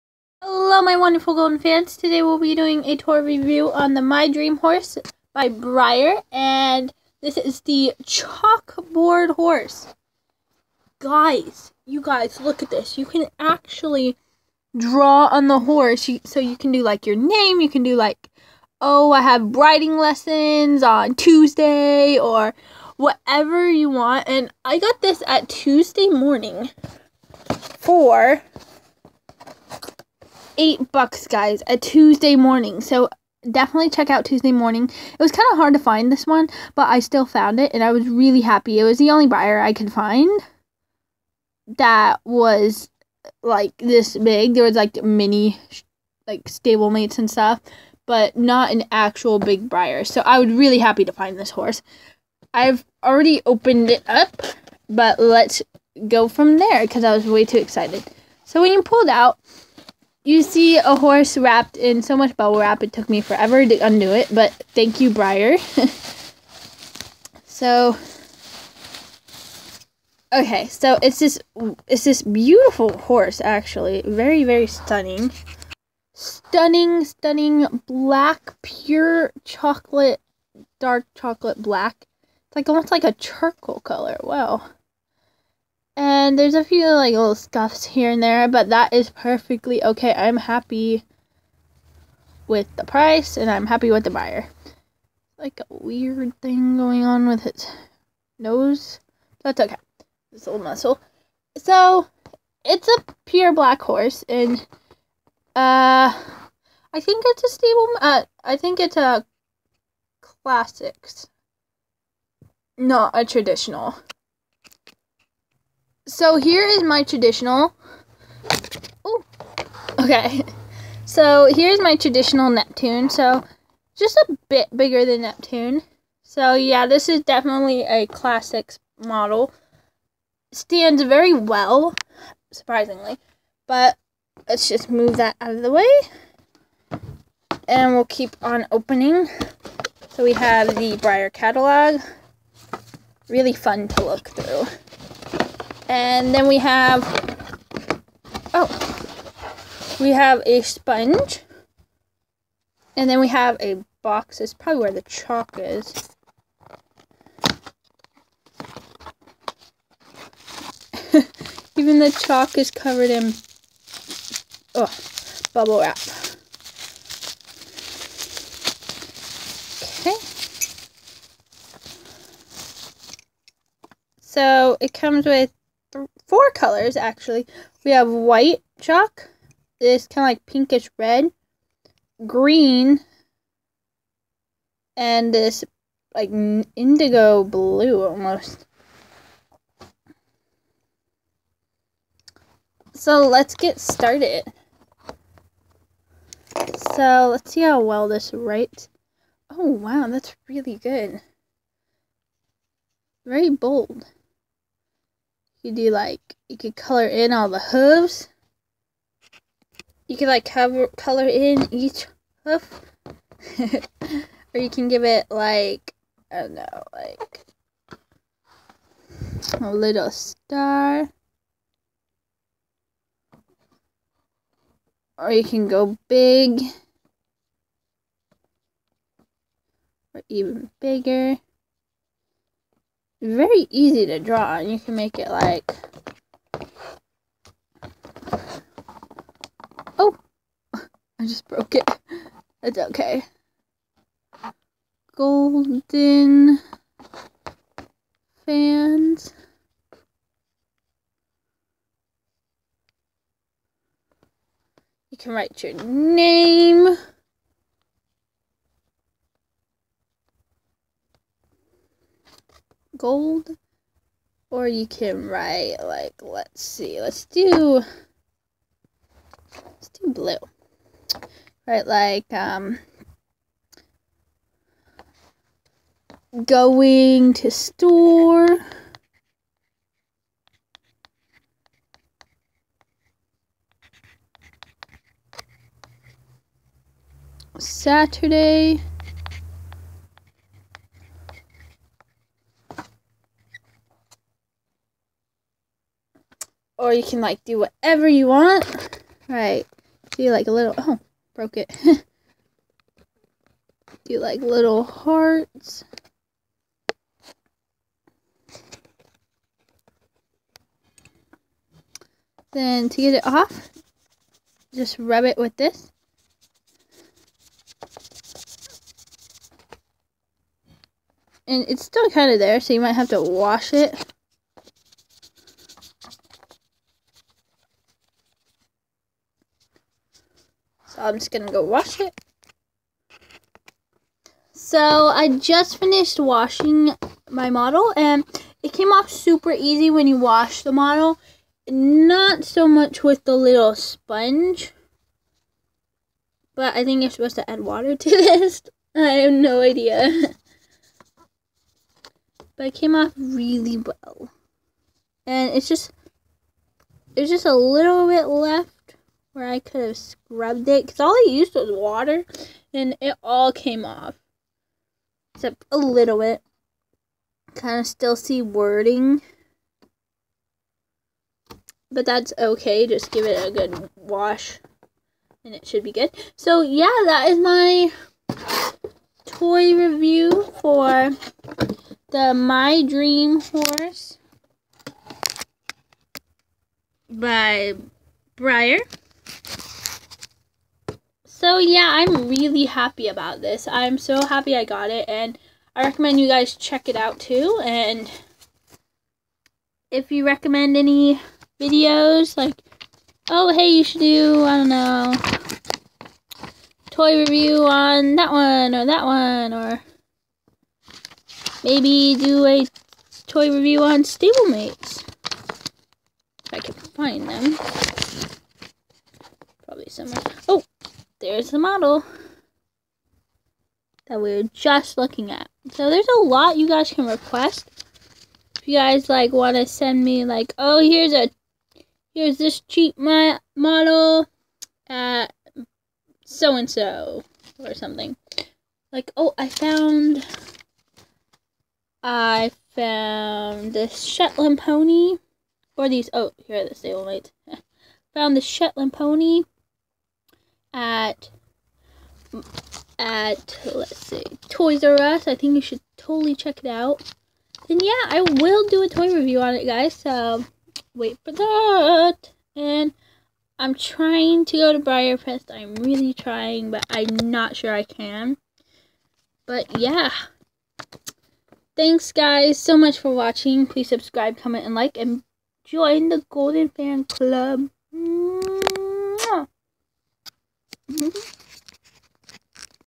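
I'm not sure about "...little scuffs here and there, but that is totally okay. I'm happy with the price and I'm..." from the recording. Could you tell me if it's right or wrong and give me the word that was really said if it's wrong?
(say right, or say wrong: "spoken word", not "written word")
wrong: "perfectly", not "totally".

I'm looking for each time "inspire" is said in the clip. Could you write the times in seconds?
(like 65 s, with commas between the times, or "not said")
not said.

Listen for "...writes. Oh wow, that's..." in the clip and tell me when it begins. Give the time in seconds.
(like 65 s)
198 s.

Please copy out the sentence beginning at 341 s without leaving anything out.
Not so much with the little sponge.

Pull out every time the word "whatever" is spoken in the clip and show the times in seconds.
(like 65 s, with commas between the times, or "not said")
22 s, 297 s.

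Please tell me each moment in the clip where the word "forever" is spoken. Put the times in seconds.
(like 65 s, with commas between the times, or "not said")
63 s.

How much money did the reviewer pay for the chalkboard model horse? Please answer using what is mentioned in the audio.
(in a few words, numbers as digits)
$8.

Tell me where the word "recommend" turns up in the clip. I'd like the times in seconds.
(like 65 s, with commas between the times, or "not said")
395 s, 400 s.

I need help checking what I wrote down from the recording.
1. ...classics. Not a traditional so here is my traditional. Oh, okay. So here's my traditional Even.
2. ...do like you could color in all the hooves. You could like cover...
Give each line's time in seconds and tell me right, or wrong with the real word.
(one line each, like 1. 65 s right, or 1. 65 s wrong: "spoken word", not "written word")
1. 110 s wrong: "Neptune", not "Even"
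2. 205 s right.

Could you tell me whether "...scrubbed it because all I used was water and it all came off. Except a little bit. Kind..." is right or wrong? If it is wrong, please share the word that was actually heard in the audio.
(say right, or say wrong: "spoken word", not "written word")
right.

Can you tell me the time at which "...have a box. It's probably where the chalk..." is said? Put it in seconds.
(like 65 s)
153 s.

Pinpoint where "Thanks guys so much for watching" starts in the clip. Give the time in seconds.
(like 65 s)
471 s.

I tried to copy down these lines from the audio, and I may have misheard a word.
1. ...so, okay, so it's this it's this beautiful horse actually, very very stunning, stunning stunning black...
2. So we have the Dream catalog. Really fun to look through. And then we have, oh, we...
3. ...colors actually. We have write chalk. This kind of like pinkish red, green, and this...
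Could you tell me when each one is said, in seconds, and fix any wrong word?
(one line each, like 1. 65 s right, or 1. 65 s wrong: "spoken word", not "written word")
1. 67 s right
2. 140 s wrong: "Breyer", not "Dream"
3. 176 s wrong: "white", not "write".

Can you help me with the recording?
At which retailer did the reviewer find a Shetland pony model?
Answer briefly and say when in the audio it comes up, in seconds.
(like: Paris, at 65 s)
Toys R Us, at 454 s.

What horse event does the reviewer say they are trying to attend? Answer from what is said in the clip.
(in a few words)
BreyerFest.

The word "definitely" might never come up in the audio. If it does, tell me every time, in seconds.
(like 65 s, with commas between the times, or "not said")
33 s, 127 s.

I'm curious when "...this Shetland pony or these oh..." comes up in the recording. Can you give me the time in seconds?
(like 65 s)
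443 s.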